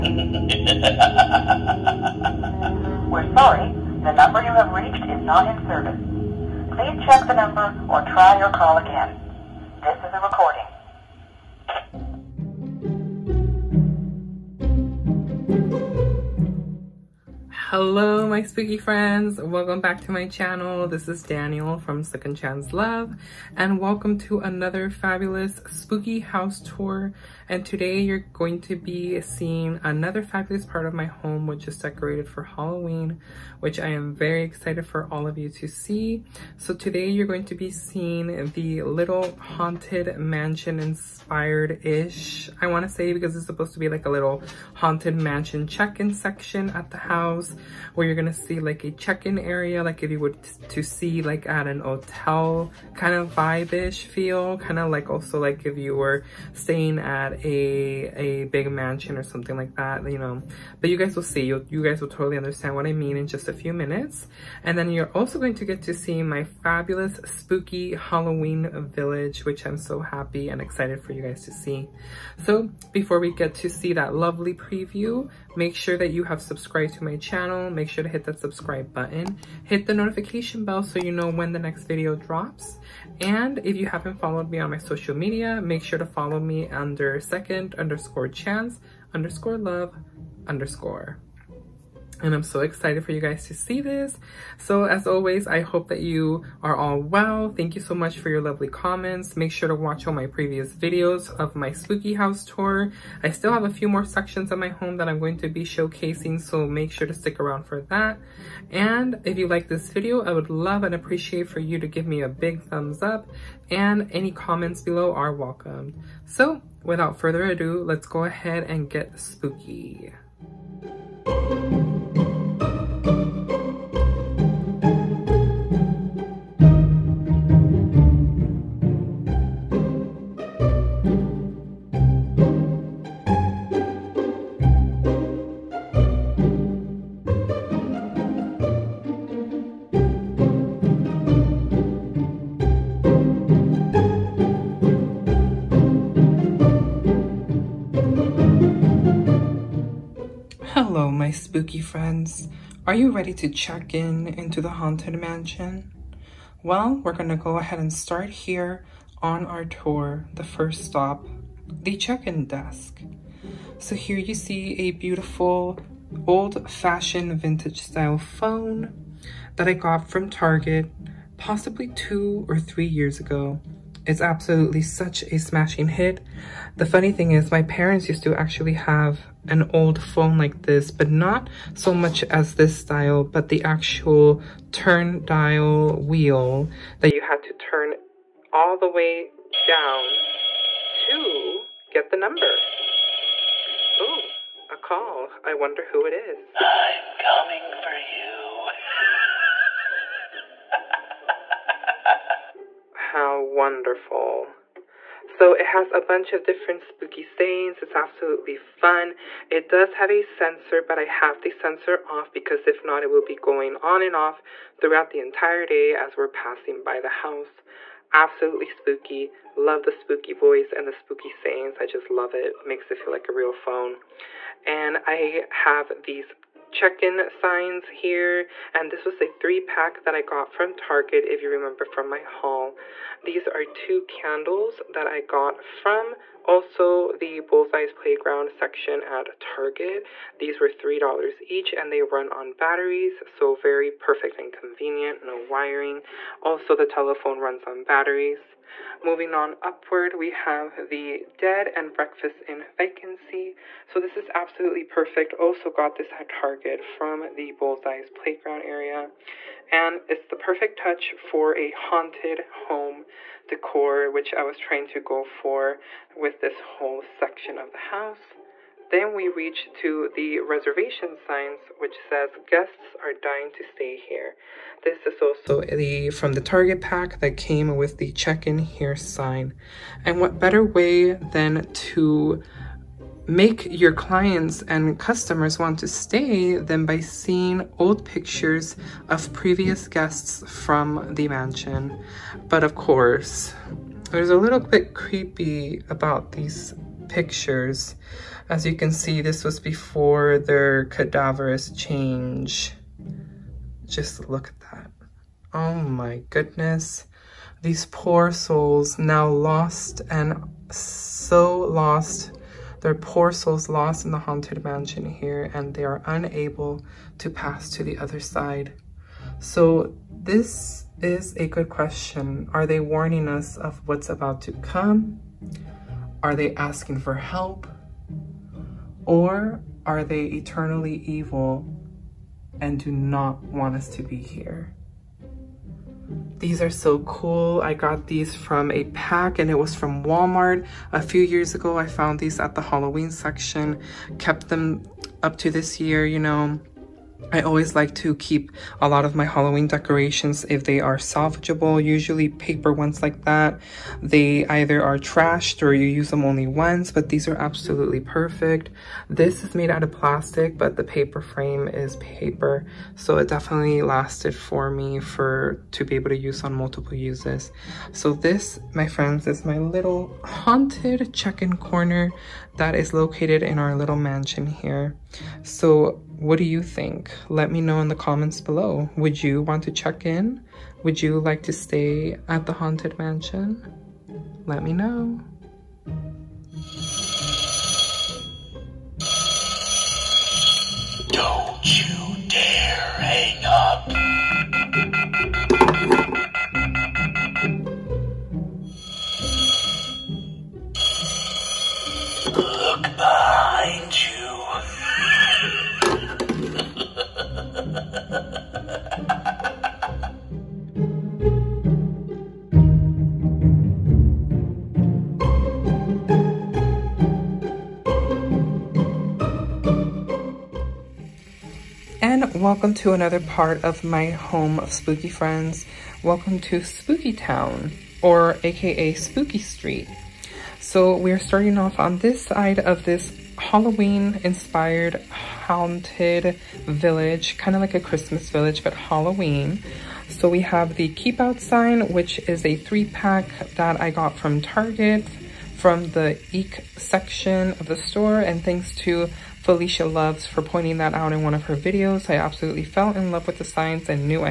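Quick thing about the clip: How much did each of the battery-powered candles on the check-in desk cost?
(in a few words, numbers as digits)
$3.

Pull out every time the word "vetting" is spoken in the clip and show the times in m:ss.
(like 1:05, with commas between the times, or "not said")
not said.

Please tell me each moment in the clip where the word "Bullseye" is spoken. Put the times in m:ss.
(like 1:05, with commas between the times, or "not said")
3:57, 4:17.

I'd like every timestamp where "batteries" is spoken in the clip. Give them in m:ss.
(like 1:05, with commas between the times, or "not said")
4:02, 4:07.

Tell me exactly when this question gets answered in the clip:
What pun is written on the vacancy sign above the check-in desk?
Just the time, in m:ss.
4:11.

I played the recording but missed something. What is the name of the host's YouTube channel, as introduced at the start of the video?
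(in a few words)
Second Chance Love.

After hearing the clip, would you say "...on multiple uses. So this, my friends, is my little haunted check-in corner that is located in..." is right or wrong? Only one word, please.
right.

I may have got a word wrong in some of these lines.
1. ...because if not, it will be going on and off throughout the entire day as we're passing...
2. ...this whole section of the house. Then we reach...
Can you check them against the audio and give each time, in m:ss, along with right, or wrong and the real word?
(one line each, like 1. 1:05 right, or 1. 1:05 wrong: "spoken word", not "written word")
1. 3:32 right
2. 4:26 right.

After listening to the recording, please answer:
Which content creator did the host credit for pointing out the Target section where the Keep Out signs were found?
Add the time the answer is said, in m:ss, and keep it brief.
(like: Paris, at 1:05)
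Felicia Loves, at 7:29.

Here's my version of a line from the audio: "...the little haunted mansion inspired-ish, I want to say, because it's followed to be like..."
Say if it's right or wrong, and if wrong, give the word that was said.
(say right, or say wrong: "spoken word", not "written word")
wrong: "supposed", not "followed".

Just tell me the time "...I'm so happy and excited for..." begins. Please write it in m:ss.
1:09.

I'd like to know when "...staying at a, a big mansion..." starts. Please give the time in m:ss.
0:56.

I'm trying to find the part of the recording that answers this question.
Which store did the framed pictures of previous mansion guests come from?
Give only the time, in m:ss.
5:40.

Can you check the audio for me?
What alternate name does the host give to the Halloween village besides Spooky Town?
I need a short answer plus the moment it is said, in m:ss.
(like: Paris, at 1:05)
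Spooky Street, at 7:08.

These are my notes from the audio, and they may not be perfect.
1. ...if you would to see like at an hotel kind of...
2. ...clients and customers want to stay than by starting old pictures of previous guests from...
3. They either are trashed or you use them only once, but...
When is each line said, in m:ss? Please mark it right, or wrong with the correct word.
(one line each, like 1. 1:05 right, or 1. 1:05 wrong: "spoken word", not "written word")
1. 0:50 right
2. 4:43 wrong: "seeing", not "starting"
3. 5:54 right.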